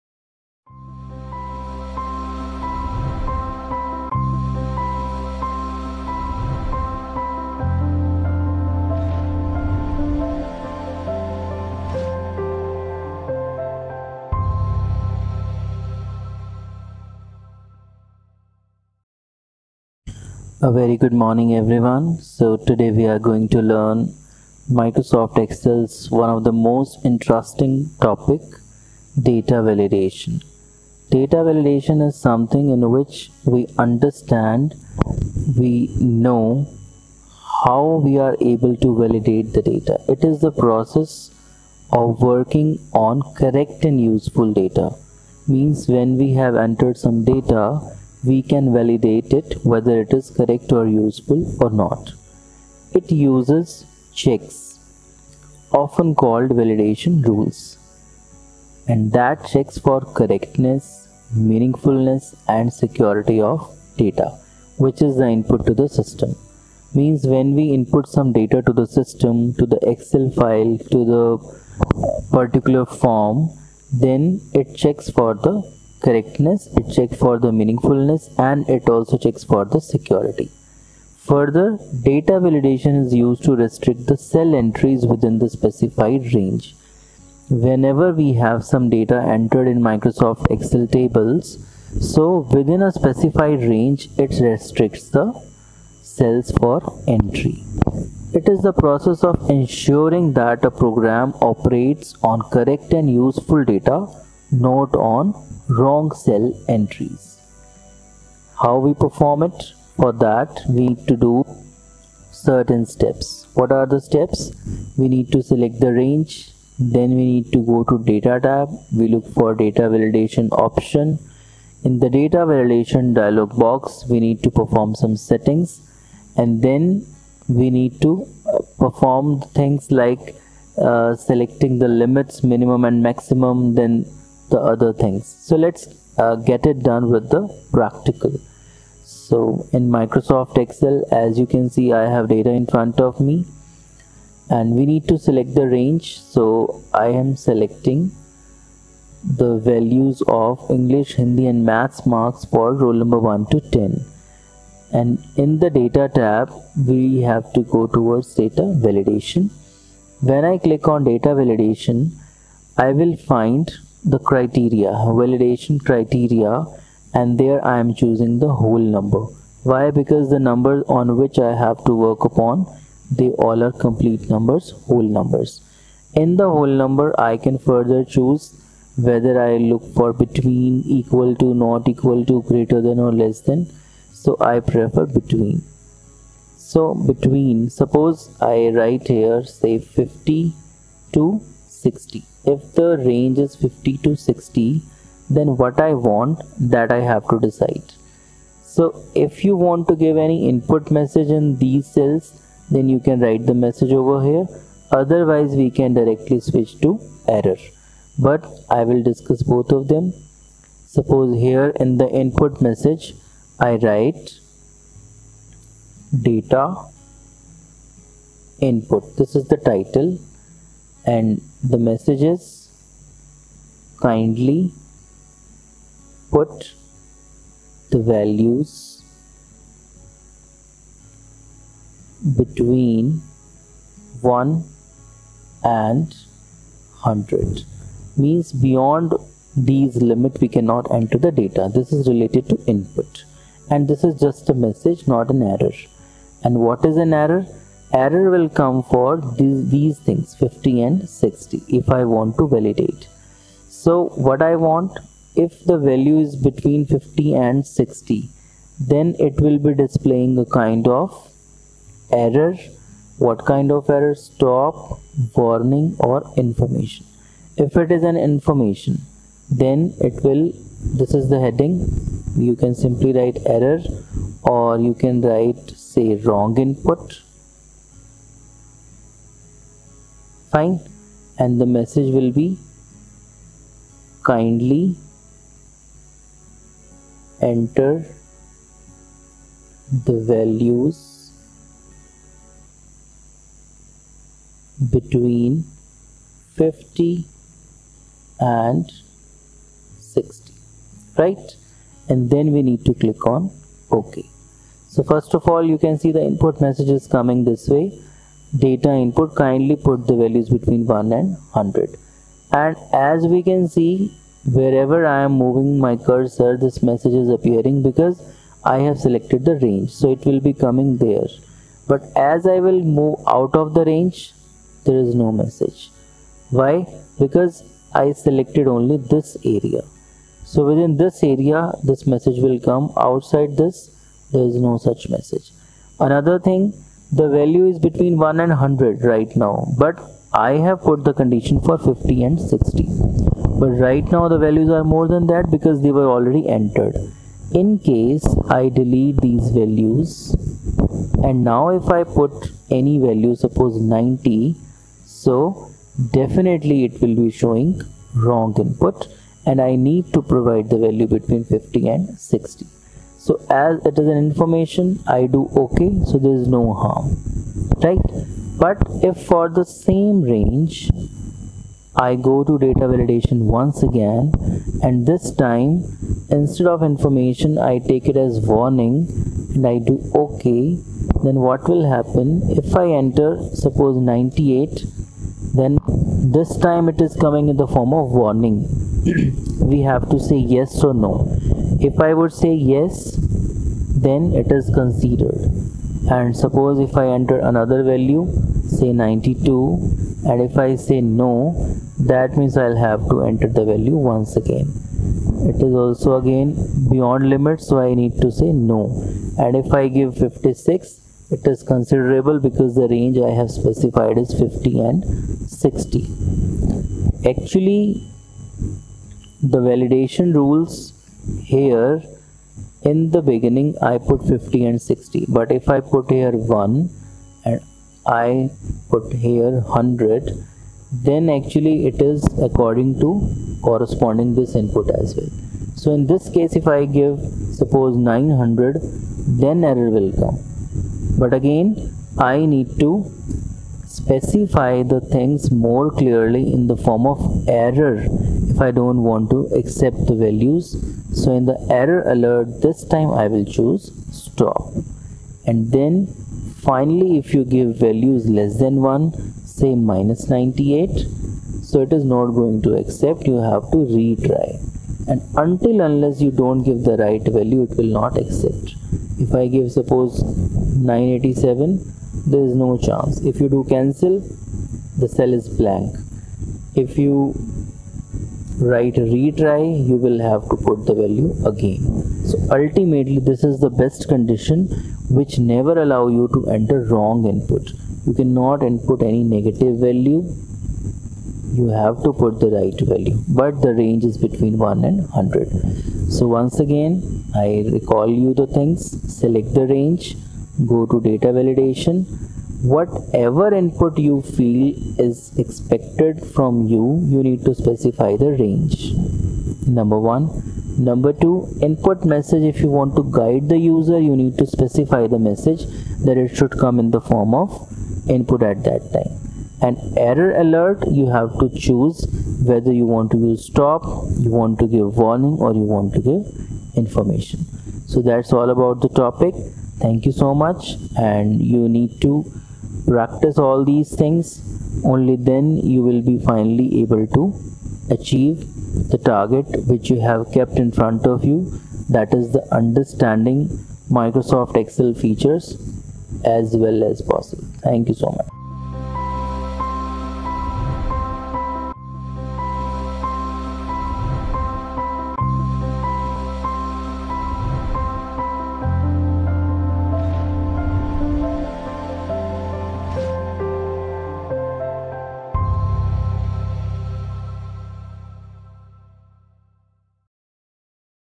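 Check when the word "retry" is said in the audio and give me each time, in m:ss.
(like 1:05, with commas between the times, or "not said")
7:43, 7:59.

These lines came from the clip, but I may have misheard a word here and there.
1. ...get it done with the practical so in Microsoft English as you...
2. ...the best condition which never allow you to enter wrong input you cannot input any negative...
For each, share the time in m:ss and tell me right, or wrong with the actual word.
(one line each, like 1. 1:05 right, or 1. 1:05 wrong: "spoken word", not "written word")
1. 2:16 wrong: "Excel", not "English"
2. 8:03 right.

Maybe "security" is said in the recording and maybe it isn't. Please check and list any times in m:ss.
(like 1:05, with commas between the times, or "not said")
1:02, 1:19.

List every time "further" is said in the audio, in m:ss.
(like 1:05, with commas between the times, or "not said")
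1:21, 2:57.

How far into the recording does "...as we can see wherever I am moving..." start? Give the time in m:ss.
5:12.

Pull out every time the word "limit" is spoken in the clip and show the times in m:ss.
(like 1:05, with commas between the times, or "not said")
2:11, 3:59, 6:47.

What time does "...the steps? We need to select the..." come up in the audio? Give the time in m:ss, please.
1:53.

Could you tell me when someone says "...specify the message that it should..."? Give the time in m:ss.
8:34.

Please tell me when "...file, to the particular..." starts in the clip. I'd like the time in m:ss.
1:10.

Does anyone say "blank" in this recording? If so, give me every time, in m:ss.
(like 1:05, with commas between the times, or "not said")
7:55.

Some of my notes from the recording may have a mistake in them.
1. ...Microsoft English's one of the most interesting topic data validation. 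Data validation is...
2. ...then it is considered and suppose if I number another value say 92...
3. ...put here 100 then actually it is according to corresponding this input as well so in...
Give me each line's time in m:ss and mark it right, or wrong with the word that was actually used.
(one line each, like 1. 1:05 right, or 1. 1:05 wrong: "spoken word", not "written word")
1. 0:24 wrong: "Excel", not "English"
2. 6:34 wrong: "enter", not "number"
3. 7:08 right.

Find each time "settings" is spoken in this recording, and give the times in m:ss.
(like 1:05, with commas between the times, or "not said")
2:05.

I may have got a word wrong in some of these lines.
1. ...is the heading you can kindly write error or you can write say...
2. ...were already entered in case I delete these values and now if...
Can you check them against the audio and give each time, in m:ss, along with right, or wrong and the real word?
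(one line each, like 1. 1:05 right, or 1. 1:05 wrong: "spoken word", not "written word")
1. 4:31 wrong: "simply", not "kindly"
2. 5:45 right.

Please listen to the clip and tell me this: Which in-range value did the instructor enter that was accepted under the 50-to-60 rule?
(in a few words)
56.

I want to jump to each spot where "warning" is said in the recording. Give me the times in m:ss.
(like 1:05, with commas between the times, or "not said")
4:25, 6:18, 6:28, 8:44.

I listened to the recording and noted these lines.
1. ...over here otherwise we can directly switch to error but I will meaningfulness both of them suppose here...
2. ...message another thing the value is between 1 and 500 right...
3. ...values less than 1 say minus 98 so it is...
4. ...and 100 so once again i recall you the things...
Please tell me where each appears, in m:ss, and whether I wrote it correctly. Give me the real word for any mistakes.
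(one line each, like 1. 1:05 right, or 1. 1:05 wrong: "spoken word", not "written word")
1. 3:23 wrong: "discuss", not "meaningfulness"
2. 5:35 wrong: "100", not "500"
3. 7:37 right
4. 8:14 right.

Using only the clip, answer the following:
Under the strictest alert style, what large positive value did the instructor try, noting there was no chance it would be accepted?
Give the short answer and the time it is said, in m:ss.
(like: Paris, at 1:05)
987, at 7:50.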